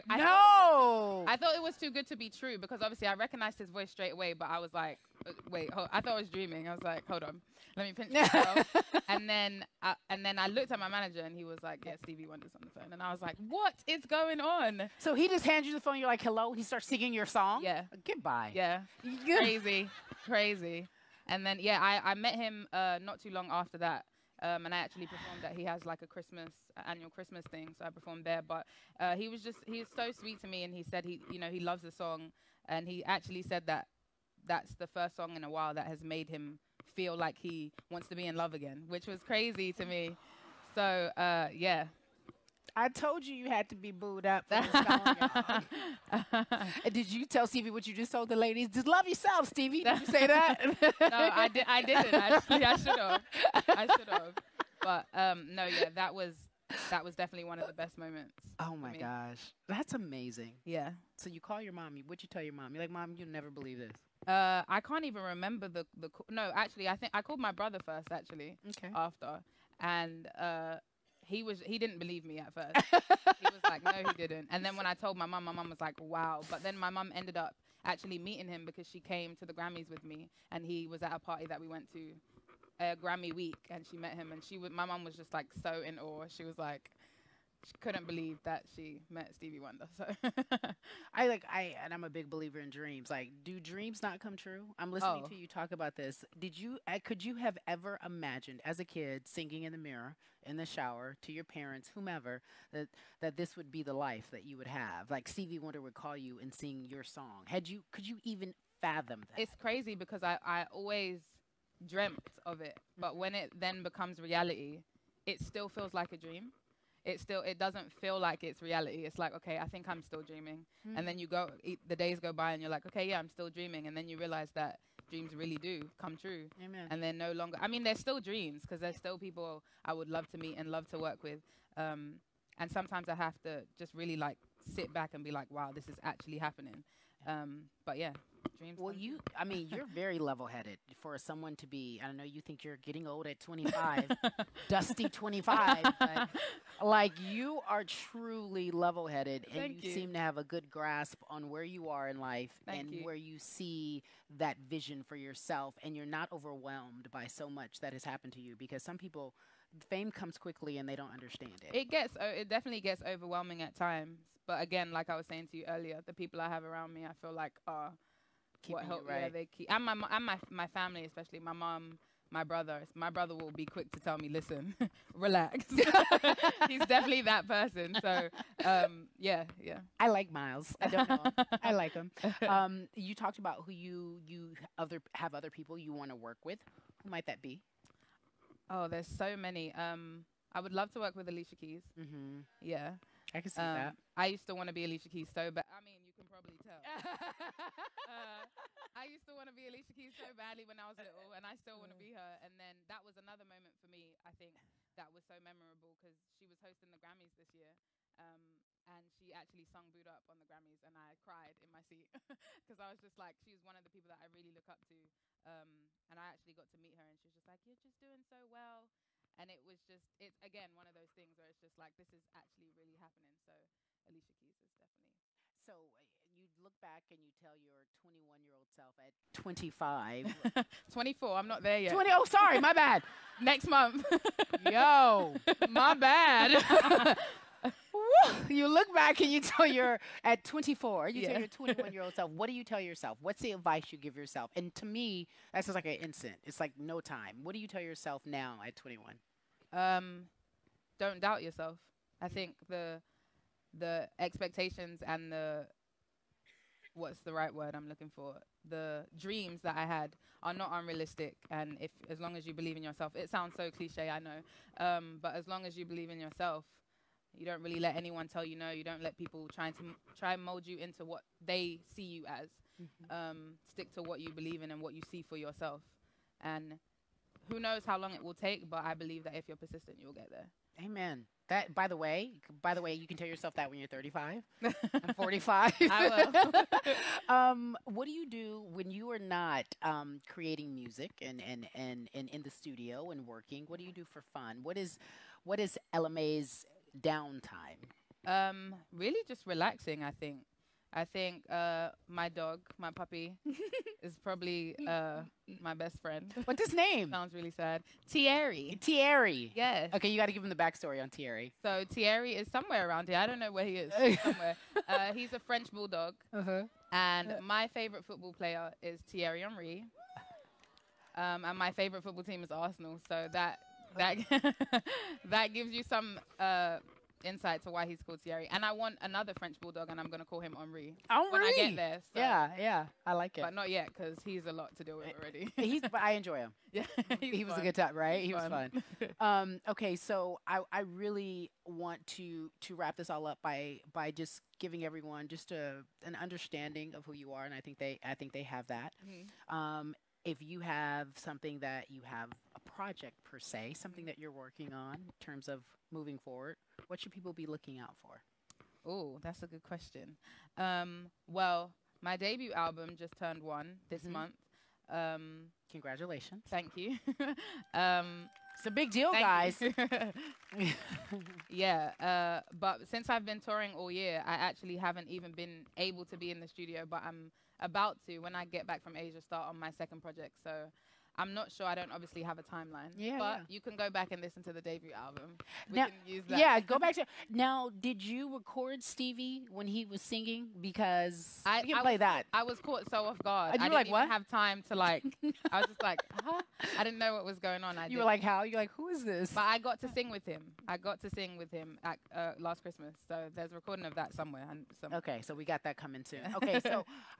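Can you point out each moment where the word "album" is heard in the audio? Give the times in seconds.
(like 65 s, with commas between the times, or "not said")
362 s, 384 s.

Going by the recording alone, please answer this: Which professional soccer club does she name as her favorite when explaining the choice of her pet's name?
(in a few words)
Arsenal.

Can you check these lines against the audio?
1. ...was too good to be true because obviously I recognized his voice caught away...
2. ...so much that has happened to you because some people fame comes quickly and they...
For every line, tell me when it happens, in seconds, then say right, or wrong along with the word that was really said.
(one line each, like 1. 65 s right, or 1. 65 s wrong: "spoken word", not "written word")
1. 1 s wrong: "straight", not "caught"
2. 157 s right.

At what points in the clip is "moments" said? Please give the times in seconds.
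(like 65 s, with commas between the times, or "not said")
57 s, 203 s.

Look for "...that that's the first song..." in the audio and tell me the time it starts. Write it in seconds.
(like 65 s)
33 s.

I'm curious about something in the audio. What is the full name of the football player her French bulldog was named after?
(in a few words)
Thierry Henry.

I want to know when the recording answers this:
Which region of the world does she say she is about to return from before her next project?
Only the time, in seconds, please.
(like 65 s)
378 s.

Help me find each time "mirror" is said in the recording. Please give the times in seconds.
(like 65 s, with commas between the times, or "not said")
99 s.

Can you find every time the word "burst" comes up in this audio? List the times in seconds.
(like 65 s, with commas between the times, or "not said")
not said.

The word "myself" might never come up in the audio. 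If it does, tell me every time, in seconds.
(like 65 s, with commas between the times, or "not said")
8 s.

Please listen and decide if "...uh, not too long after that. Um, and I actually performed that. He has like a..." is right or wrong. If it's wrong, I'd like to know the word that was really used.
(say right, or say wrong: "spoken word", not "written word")
right.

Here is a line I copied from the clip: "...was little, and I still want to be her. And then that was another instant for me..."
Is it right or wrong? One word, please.
wrong.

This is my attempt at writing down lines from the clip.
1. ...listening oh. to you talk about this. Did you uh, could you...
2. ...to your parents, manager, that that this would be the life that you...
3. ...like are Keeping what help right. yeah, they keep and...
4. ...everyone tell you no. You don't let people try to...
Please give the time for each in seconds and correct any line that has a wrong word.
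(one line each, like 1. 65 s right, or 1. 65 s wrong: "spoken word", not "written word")
1. 94 s right
2. 101 s wrong: "whomever", not "manager"
3. 167 s right
4. 267 s wrong: "anyone", not "everyone".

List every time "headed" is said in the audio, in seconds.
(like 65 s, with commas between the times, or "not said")
140 s, 149 s.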